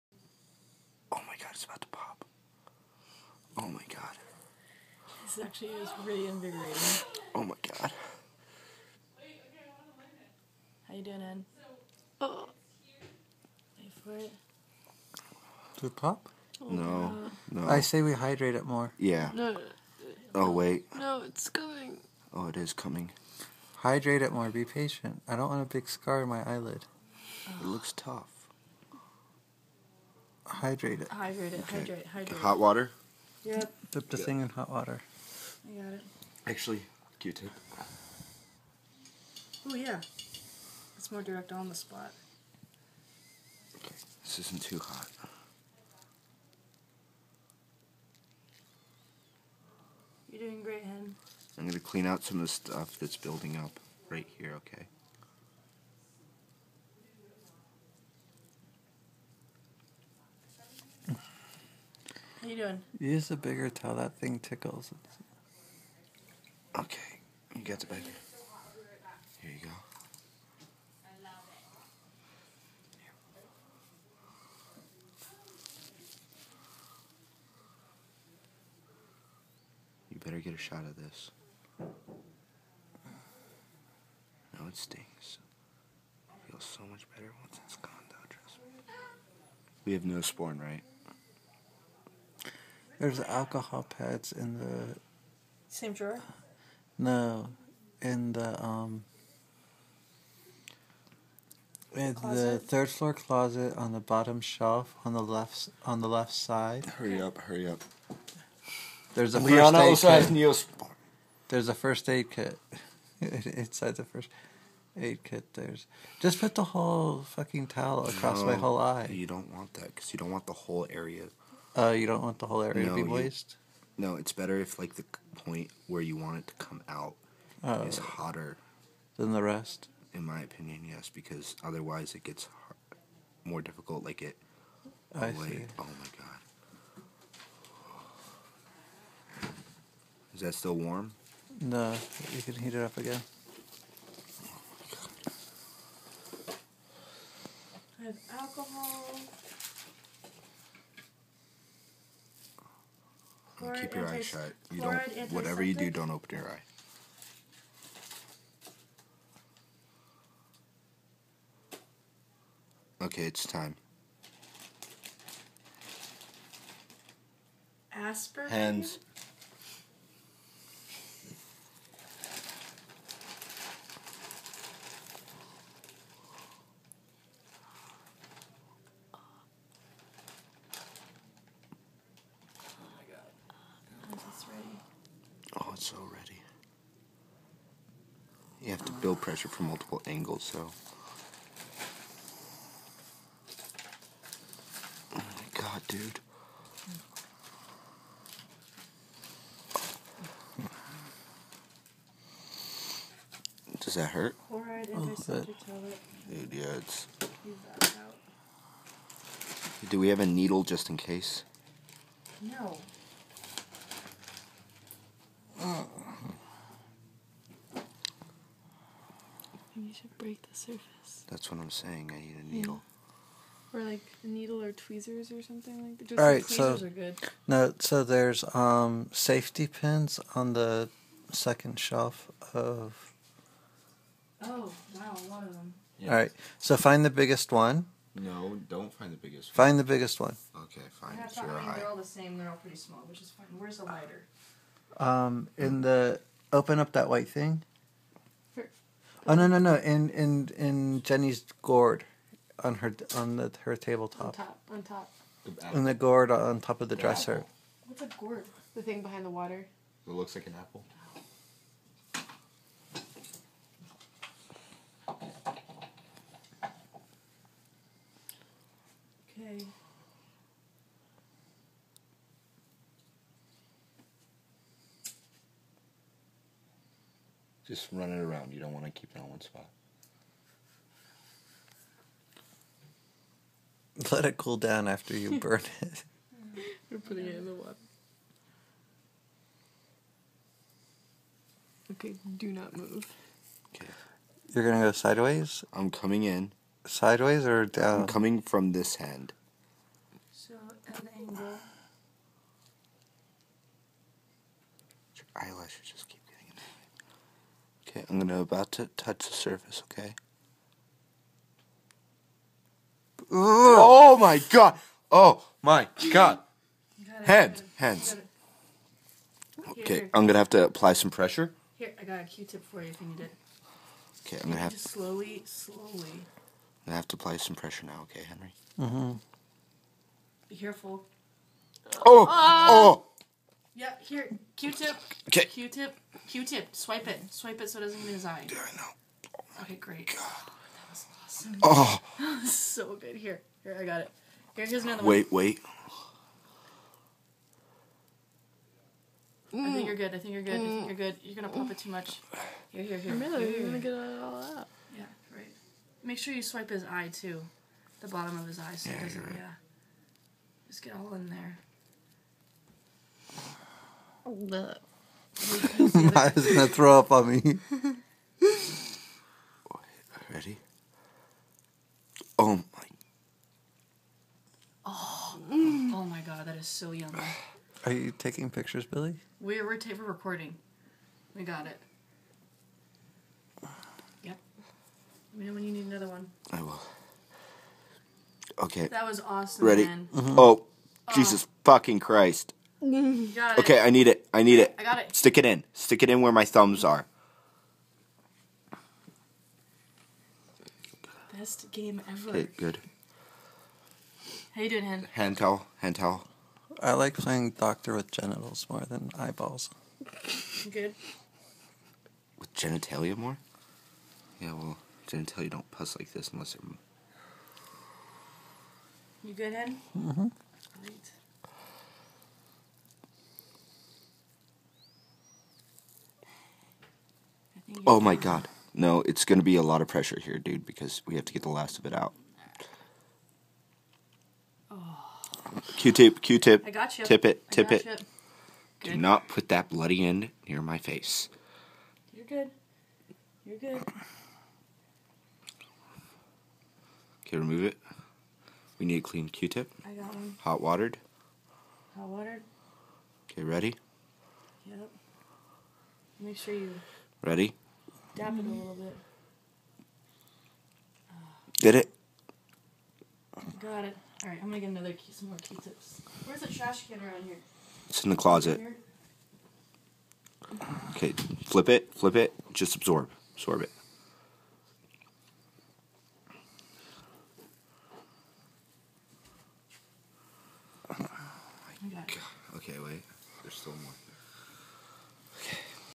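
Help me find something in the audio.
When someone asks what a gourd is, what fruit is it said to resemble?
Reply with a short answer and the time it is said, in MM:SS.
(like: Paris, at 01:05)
An apple, at 04:20.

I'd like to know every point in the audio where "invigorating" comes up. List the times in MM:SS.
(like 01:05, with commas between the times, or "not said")
00:06.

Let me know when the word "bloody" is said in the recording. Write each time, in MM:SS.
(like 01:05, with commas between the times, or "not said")
07:19.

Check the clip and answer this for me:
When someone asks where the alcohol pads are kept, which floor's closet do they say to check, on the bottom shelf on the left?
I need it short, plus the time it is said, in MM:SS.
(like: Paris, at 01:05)
Third floor, at 01:42.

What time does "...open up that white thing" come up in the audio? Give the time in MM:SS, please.
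04:06.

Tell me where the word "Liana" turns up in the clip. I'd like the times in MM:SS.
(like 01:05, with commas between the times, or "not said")
01:49.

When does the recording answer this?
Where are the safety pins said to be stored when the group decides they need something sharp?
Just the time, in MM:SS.
03:51.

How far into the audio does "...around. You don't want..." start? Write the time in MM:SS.
04:38.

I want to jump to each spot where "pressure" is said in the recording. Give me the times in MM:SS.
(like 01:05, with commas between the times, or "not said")
03:09, 05:21, 05:27, 07:09.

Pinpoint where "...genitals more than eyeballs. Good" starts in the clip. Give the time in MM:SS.
06:48.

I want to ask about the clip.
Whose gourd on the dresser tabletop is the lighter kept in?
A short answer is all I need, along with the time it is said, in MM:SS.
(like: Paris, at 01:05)
Jenny's, at 04:11.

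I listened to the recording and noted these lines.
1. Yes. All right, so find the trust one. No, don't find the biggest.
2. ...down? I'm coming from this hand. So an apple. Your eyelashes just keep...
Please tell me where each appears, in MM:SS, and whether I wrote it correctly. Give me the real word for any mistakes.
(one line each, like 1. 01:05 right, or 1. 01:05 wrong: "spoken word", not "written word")
1. 03:55 wrong: "biggest", not "trust"
2. 04:57 wrong: "angle", not "apple".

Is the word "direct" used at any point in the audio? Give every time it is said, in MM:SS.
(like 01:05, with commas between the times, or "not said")
00:41.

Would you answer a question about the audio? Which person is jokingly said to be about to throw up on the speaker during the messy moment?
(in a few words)
Maya.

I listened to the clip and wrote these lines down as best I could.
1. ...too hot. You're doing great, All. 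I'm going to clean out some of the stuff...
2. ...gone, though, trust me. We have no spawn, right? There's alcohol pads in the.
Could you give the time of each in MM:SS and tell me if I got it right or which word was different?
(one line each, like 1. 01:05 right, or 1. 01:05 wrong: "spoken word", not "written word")
1. 00:44 wrong: "Hen", not "All"
2. 01:27 right.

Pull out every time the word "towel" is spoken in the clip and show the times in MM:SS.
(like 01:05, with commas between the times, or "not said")
01:03, 01:57, 06:45.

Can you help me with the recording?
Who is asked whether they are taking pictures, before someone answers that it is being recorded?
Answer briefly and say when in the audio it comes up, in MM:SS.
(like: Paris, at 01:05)
Billy, at 06:18.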